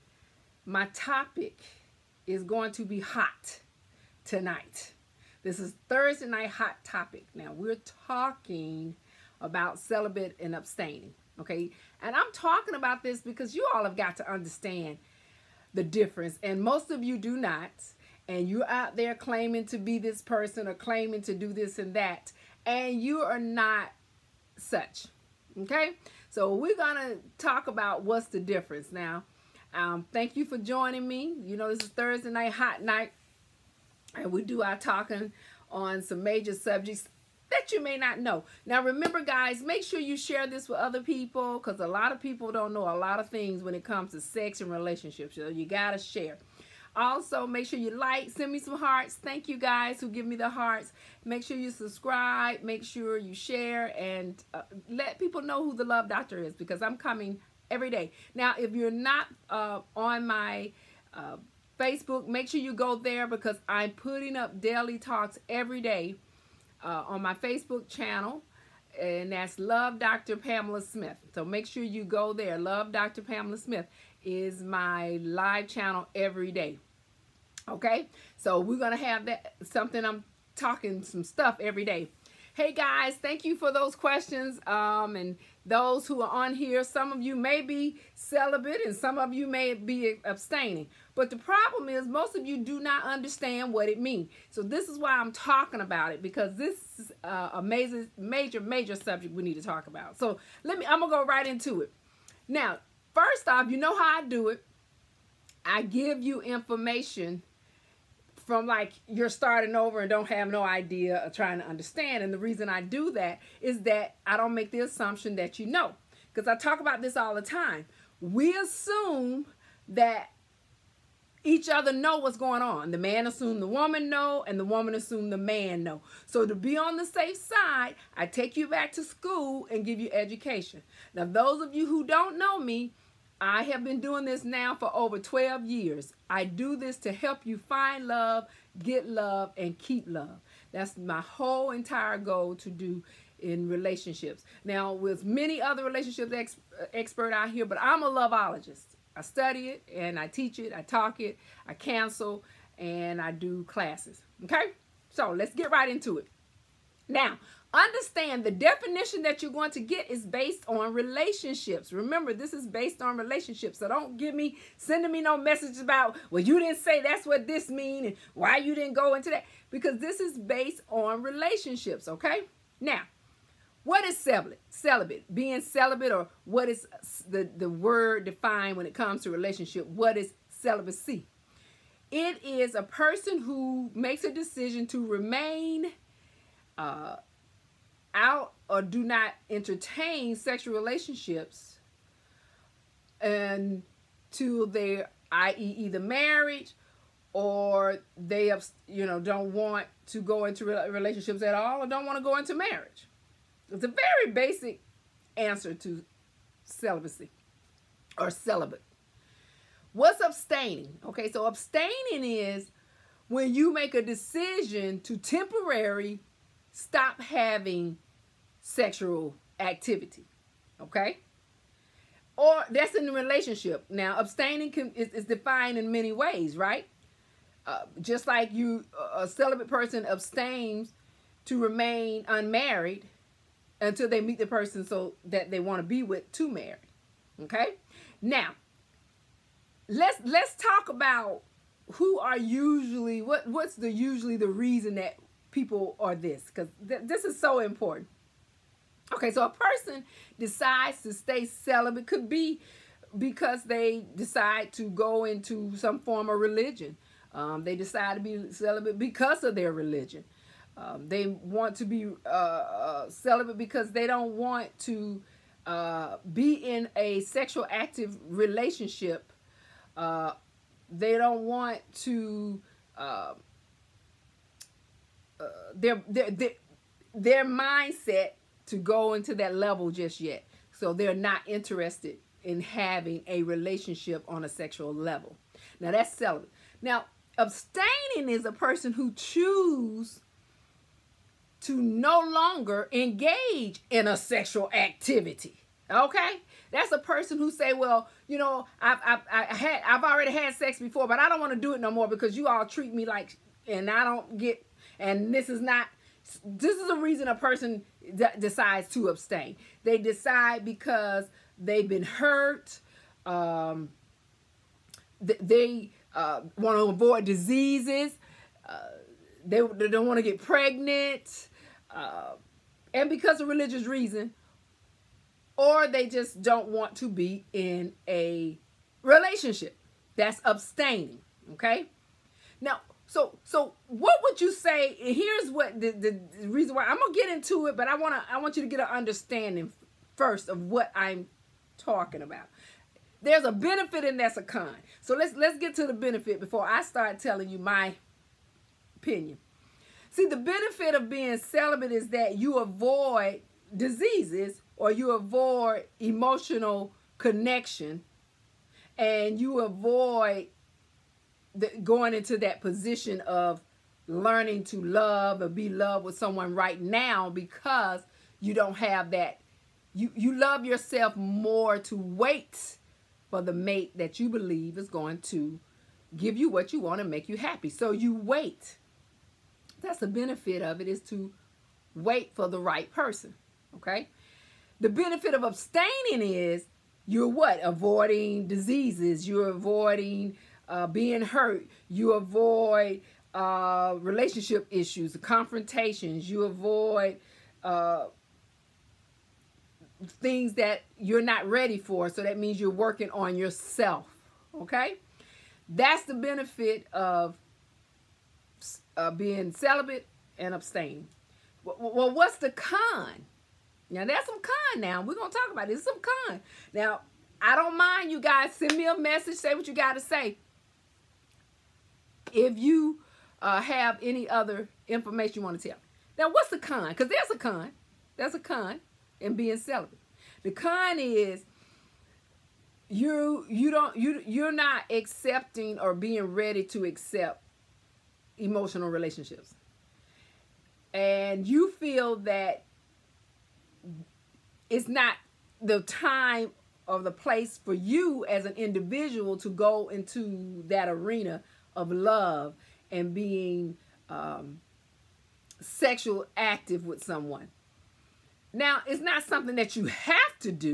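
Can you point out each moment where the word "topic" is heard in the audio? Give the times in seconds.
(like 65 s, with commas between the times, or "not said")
0 s, 6 s.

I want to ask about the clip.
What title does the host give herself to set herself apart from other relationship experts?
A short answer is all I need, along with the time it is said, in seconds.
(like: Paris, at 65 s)
loveologist, at 148 s.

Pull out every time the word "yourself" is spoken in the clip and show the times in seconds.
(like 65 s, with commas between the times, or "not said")
370 s, 403 s.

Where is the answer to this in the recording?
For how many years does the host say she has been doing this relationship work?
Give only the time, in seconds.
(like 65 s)
134 s.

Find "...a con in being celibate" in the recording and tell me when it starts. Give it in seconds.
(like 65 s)
428 s.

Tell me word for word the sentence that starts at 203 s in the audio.
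It's a very basic answer to celibacy or celibate.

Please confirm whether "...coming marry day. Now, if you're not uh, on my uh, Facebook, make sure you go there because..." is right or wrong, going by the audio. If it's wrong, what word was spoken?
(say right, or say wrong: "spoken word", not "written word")
wrong: "every", not "marry".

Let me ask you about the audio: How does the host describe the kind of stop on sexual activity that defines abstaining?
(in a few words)
temporary.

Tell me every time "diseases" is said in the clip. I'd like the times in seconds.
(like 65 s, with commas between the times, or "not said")
317 s, 353 s, 388 s.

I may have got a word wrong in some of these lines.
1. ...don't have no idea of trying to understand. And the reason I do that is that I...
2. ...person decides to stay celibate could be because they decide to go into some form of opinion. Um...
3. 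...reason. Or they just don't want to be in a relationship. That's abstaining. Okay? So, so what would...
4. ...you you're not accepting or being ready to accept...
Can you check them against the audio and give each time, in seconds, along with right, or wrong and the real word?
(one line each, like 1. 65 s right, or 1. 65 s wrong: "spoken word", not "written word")
1. 110 s right
2. 249 s wrong: "religion", not "opinion"
3. 323 s right
4. 433 s right.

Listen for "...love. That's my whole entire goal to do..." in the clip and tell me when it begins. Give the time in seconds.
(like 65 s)
140 s.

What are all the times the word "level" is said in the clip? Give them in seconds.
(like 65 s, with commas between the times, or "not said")
279 s, 284 s.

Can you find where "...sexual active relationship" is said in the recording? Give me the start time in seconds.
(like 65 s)
267 s.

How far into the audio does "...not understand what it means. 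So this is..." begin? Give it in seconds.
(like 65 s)
92 s.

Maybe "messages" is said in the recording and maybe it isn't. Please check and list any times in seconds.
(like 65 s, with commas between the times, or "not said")
165 s, 418 s.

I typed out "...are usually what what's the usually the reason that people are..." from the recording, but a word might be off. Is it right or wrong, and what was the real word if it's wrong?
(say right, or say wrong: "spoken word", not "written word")
right.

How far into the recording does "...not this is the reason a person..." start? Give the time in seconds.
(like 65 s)
305 s.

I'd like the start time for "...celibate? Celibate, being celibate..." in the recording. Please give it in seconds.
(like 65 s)
174 s.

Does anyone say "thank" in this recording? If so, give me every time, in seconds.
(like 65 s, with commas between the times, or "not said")
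30 s, 49 s, 83 s.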